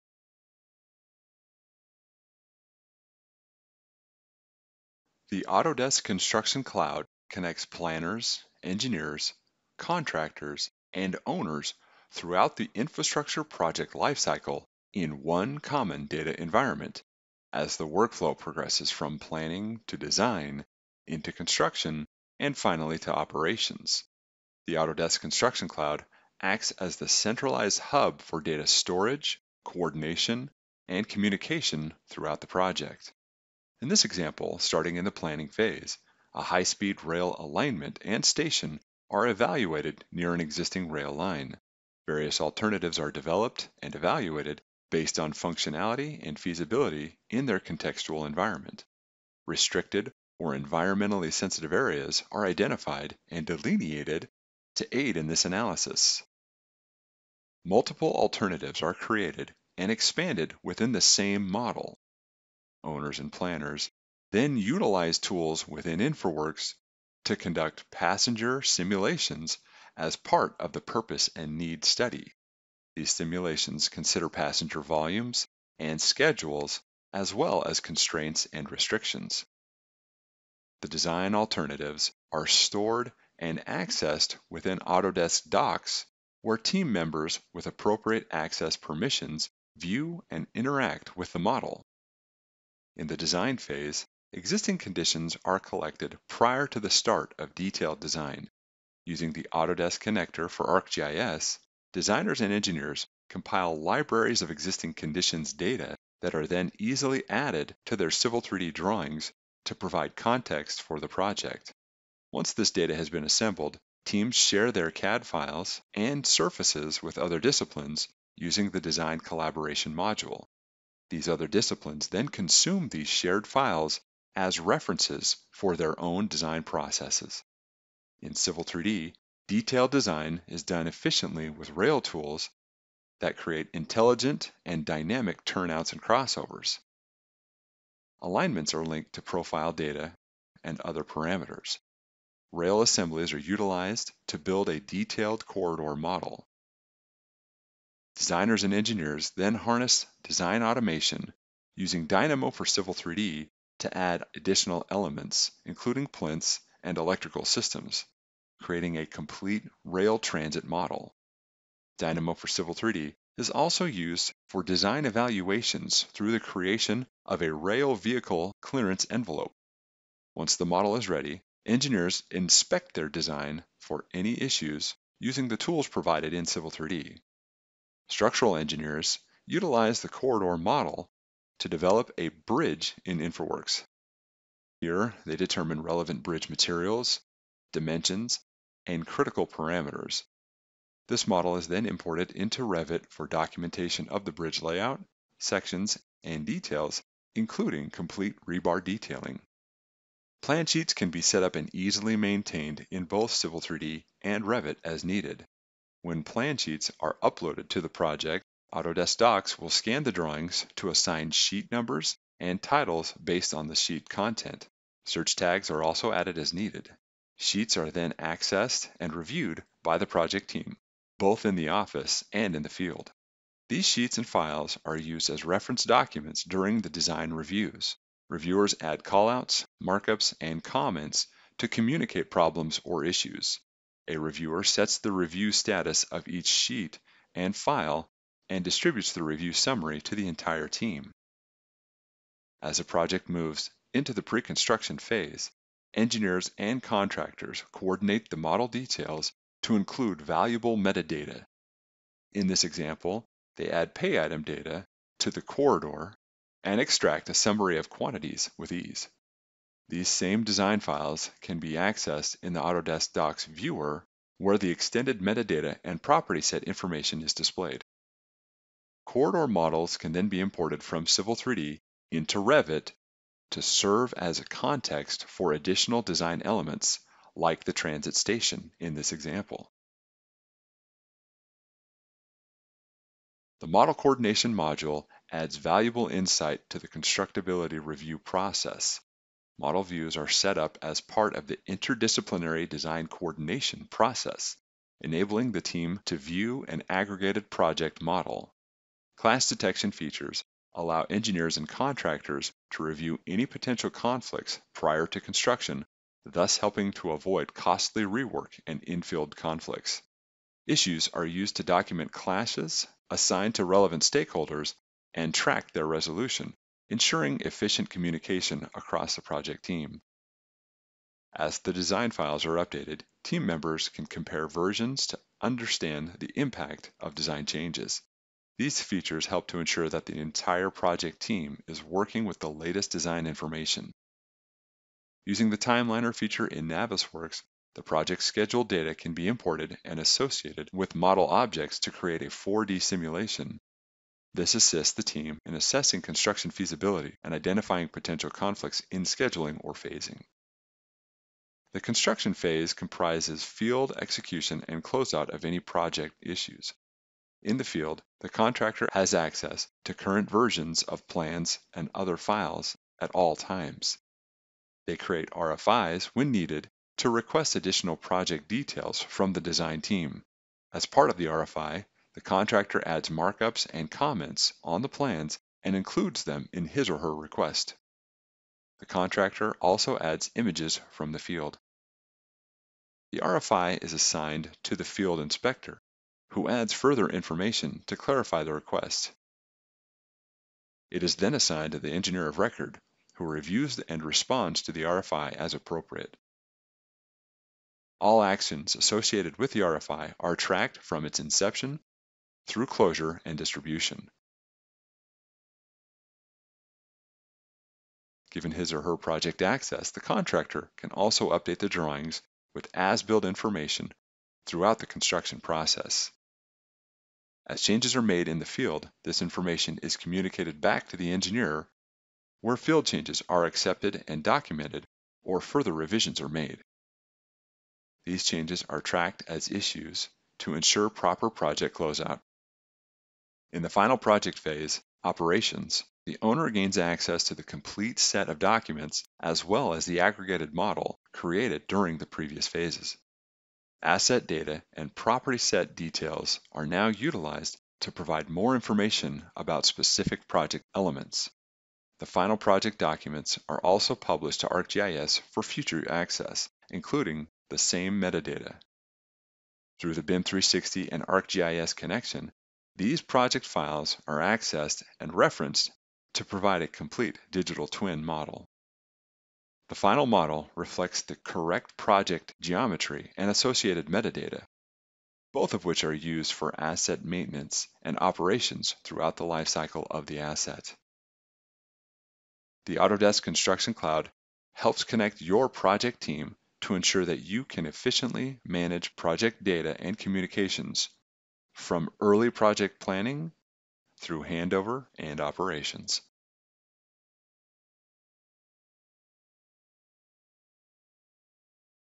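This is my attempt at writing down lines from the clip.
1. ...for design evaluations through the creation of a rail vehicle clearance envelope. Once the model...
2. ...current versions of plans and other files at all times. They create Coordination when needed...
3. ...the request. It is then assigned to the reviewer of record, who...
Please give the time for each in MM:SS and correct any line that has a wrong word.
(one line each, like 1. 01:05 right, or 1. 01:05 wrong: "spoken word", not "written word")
1. 02:44 right
2. 05:59 wrong: "RFIs", not "Coordination"
3. 06:28 wrong: "engineer", not "reviewer".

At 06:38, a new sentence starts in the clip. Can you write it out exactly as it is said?
All actions associated with the RFI are tracked from its inception through closure and distribution.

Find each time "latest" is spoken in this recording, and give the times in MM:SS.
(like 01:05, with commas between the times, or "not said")
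05:32.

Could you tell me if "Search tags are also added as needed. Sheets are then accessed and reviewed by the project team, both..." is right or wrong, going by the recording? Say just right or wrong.
right.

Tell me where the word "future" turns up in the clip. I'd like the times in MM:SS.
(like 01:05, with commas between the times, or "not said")
07:35.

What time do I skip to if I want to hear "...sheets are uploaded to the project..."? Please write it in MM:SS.
03:26.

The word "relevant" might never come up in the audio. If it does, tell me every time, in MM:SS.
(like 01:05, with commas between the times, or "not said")
03:05, 05:13.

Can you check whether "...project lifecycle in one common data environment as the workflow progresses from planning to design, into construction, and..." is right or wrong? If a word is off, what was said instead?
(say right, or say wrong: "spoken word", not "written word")
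right.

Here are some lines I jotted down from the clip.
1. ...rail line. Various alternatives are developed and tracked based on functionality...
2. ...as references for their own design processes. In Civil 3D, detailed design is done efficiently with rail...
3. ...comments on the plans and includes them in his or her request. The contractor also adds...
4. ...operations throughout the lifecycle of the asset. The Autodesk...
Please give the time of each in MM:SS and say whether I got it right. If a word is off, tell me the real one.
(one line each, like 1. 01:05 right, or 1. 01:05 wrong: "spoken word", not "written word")
1. 00:40 wrong: "evaluated", not "tracked"
2. 02:04 right
3. 06:13 right
4. 07:57 right.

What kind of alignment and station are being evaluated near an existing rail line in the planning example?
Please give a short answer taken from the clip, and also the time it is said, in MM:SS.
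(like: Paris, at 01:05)
high-speed rail, at 00:36.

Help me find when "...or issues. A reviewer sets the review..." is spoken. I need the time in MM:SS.
03:52.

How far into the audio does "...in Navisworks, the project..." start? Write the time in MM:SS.
05:36.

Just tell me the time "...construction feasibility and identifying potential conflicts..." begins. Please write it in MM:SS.
05:46.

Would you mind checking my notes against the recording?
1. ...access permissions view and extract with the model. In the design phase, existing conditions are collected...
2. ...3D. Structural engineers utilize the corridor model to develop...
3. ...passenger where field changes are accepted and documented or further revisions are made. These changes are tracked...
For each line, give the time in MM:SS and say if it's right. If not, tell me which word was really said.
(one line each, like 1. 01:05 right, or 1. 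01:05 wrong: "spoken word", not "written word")
1. 01:28 wrong: "interact", not "extract"
2. 02:56 right
3. 07:01 wrong: "engineer", not "passenger".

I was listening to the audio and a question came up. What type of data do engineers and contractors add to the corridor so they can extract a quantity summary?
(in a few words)
pay item data.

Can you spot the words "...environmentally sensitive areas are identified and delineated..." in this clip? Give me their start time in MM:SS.
00:50.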